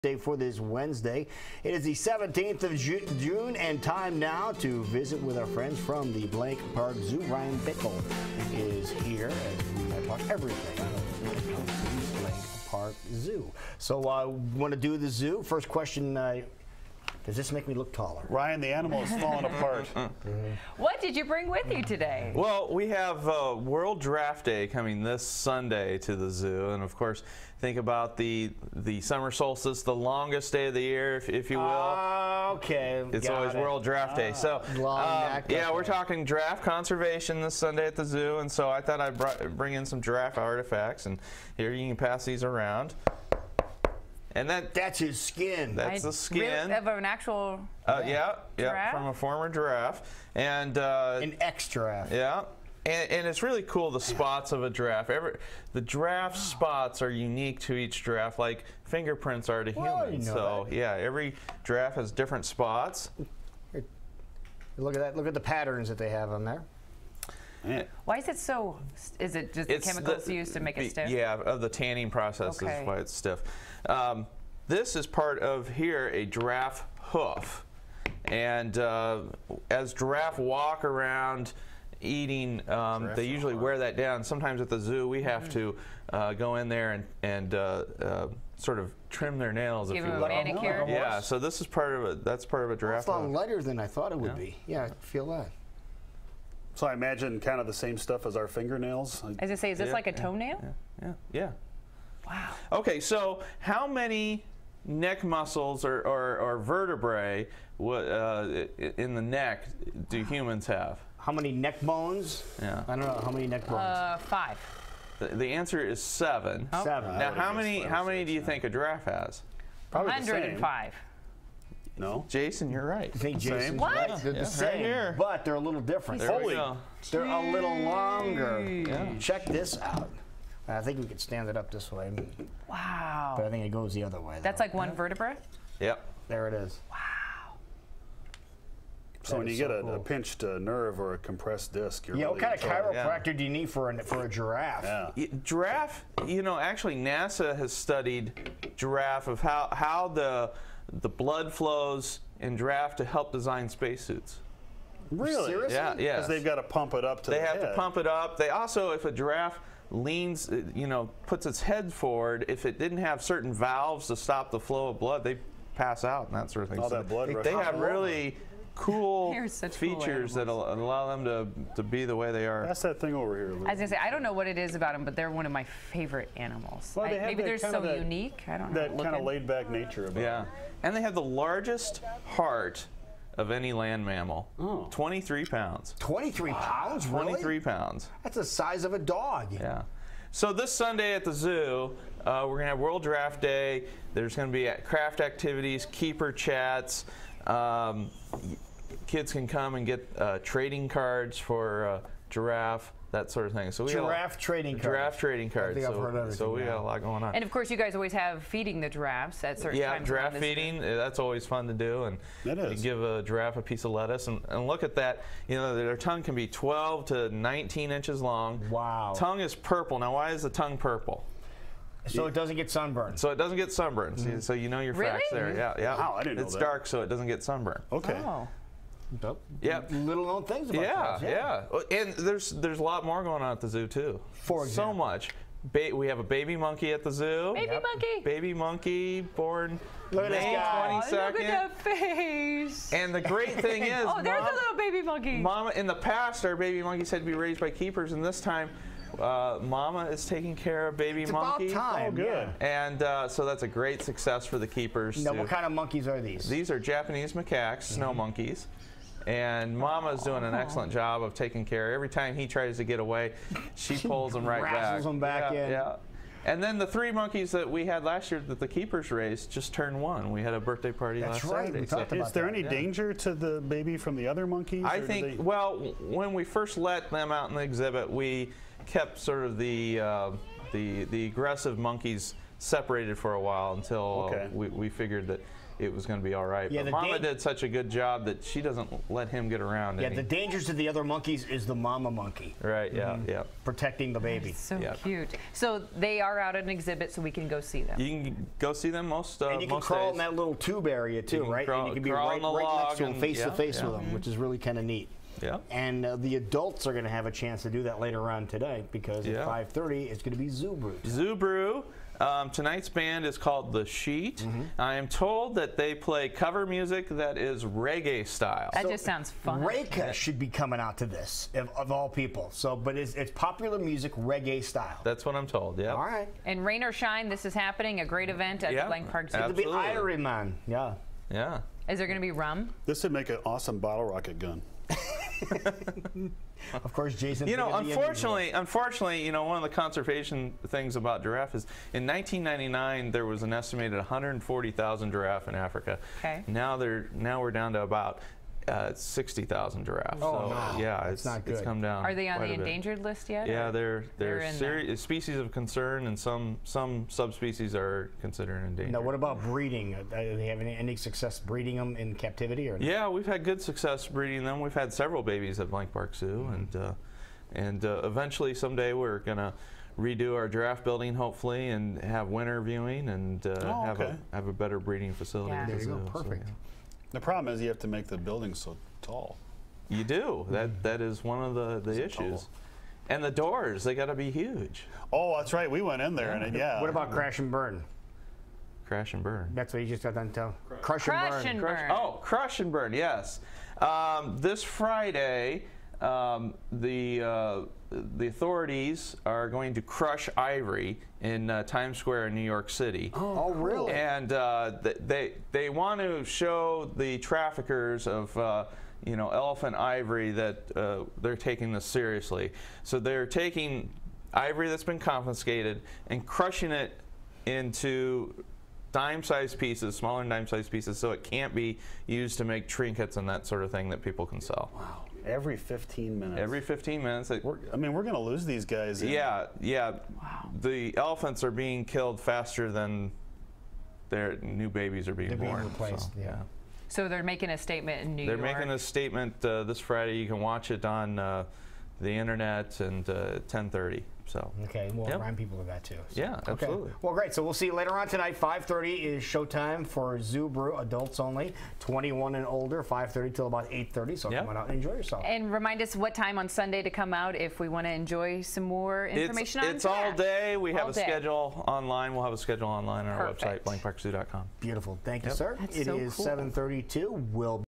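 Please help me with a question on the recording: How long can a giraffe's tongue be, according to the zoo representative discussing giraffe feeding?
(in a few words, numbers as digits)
12 to 19 inches.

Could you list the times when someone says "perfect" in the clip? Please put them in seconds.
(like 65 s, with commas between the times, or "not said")
376 s, 463 s.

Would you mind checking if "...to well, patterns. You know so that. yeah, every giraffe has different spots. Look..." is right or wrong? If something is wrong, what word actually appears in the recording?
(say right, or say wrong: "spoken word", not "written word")
wrong: "humans", not "patterns".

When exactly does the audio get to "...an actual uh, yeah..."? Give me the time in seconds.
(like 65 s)
46 s.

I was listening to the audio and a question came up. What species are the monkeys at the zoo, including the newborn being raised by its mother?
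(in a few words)
Japanese macaques.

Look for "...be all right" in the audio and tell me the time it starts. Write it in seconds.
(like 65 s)
286 s.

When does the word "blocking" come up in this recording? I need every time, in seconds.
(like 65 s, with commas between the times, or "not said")
not said.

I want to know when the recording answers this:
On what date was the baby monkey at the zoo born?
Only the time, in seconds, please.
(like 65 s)
240 s.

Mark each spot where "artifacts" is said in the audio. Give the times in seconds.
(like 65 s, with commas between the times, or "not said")
40 s.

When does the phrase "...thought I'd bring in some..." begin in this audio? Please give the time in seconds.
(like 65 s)
38 s.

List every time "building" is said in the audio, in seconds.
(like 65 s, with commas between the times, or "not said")
370 s, 378 s.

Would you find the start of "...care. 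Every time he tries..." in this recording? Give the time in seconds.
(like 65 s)
261 s.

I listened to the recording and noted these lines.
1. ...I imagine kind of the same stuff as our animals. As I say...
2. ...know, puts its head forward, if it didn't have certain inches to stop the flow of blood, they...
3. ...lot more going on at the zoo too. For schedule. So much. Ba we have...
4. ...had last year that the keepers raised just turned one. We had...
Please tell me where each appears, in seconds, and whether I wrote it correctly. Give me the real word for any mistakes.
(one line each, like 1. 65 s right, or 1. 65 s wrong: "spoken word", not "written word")
1. 96 s wrong: "fingernails", not "animals"
2. 160 s wrong: "valves", not "inches"
3. 232 s wrong: "example", not "schedule"
4. 267 s right.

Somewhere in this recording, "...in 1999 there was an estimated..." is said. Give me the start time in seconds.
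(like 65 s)
341 s.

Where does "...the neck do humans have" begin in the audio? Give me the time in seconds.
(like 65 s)
109 s.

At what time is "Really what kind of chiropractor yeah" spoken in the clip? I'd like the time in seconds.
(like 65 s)
142 s.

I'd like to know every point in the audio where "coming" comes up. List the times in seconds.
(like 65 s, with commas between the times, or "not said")
24 s, 320 s.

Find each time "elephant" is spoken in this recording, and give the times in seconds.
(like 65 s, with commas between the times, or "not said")
409 s, 430 s.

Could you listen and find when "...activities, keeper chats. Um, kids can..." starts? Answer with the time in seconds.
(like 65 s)
195 s.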